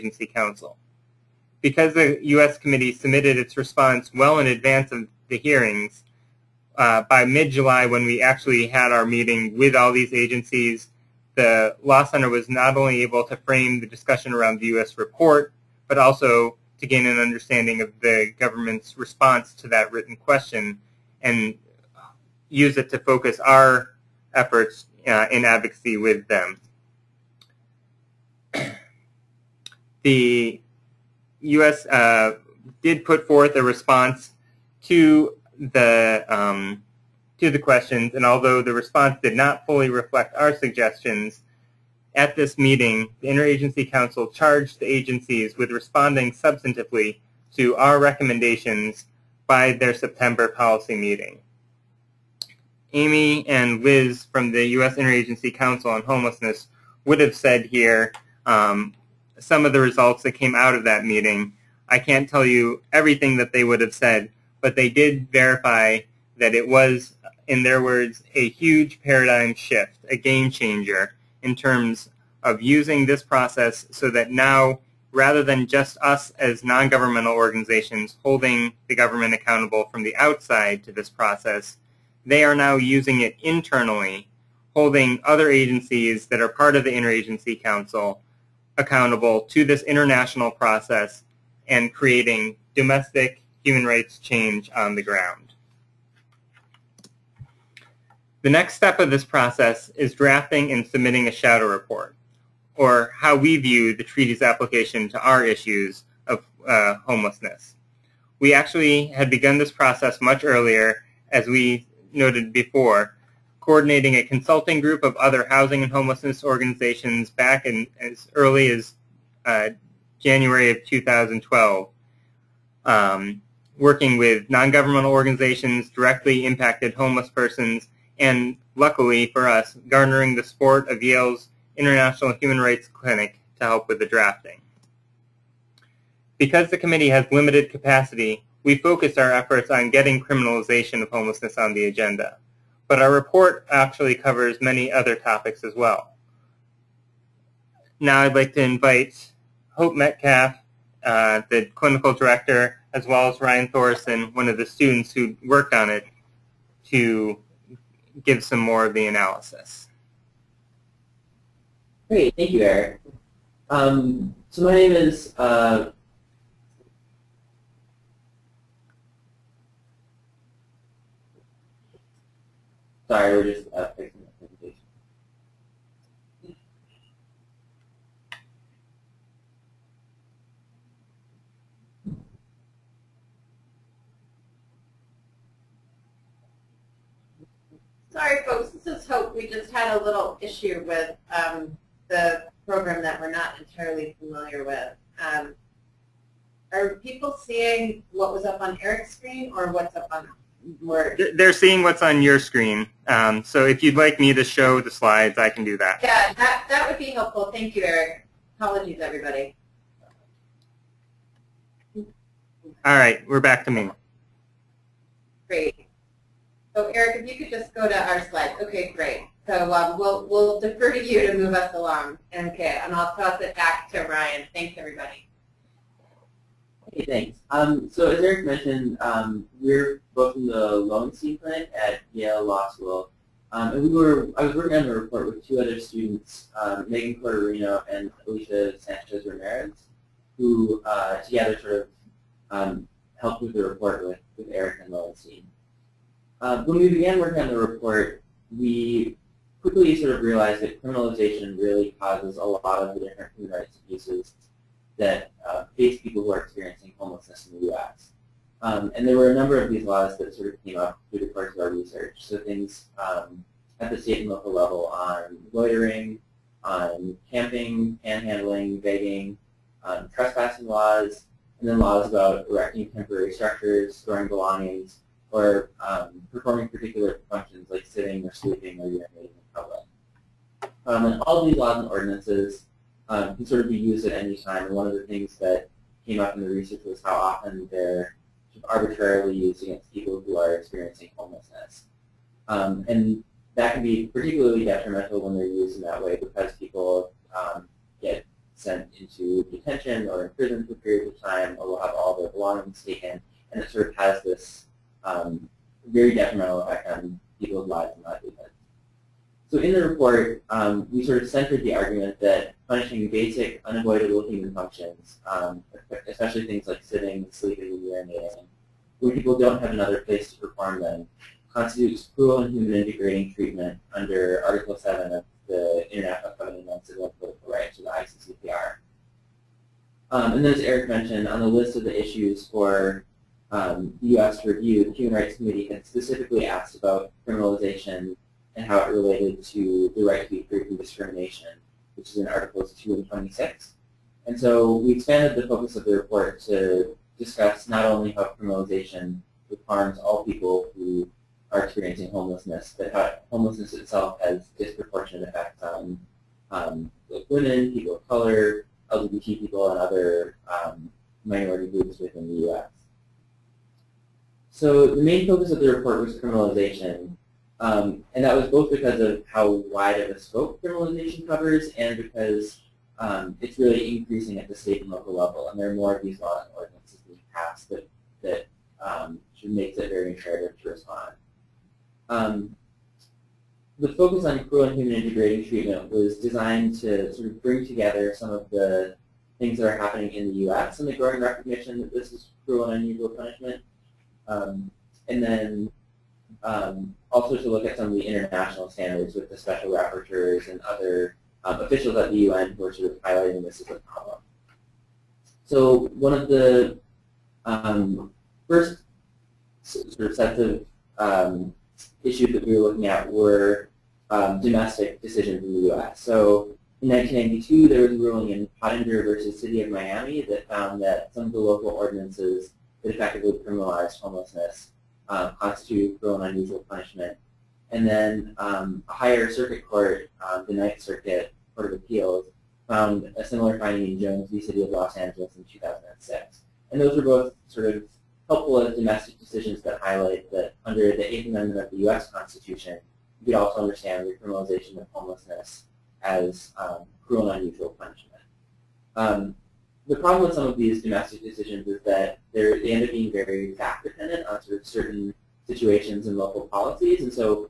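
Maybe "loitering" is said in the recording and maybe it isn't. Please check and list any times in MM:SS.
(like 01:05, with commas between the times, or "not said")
04:25.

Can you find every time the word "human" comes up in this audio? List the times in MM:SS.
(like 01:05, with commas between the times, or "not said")
01:33, 02:12, 04:13, 05:14, 05:22, 05:34, 06:24.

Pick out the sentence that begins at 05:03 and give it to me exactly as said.
And it sort of has this um, very detrimental effect on people's lives and livelihoods.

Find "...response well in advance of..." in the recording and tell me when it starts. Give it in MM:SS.
00:03.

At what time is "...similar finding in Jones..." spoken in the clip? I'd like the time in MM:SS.
07:13.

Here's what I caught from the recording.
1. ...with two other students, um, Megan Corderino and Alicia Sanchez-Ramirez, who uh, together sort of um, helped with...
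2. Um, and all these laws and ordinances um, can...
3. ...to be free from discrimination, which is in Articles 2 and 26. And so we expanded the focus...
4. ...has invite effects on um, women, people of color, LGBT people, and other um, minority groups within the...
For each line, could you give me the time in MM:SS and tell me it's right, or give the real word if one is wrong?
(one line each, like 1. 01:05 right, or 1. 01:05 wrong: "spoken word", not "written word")
1. 03:55 right
2. 04:40 right
3. 05:40 right
4. 05:54 wrong: "disproportionate", not "invite".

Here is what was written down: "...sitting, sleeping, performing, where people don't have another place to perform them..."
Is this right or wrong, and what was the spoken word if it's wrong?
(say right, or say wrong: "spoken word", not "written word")
wrong: "urinating", not "performing".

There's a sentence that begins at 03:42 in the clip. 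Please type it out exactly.
Okay, and I'll toss it back to Ryan.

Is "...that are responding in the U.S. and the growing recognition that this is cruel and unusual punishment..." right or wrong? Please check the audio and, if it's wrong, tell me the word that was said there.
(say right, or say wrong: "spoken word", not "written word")
wrong: "happening", not "responding".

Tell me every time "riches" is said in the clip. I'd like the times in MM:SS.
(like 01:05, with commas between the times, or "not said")
not said.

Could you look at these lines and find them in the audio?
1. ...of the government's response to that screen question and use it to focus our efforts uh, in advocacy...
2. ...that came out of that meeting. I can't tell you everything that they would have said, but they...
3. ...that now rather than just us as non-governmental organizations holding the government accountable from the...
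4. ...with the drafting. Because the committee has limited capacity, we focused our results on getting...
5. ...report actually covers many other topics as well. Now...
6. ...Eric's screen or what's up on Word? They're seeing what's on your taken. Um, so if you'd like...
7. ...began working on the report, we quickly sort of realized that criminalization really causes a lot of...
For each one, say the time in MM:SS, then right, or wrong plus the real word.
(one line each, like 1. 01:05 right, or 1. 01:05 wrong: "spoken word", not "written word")
1. 00:17 wrong: "written", not "screen"
2. 01:00 right
3. 01:14 right
4. 02:13 wrong: "efforts", not "results"
5. 02:23 right
6. 03:18 wrong: "screen", not "taken"
7. 04:06 right.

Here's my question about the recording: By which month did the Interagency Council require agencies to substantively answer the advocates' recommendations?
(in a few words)
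September.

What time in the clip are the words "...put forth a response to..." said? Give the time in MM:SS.
00:33.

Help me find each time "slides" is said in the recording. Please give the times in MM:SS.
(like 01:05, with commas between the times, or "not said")
03:24, 03:38.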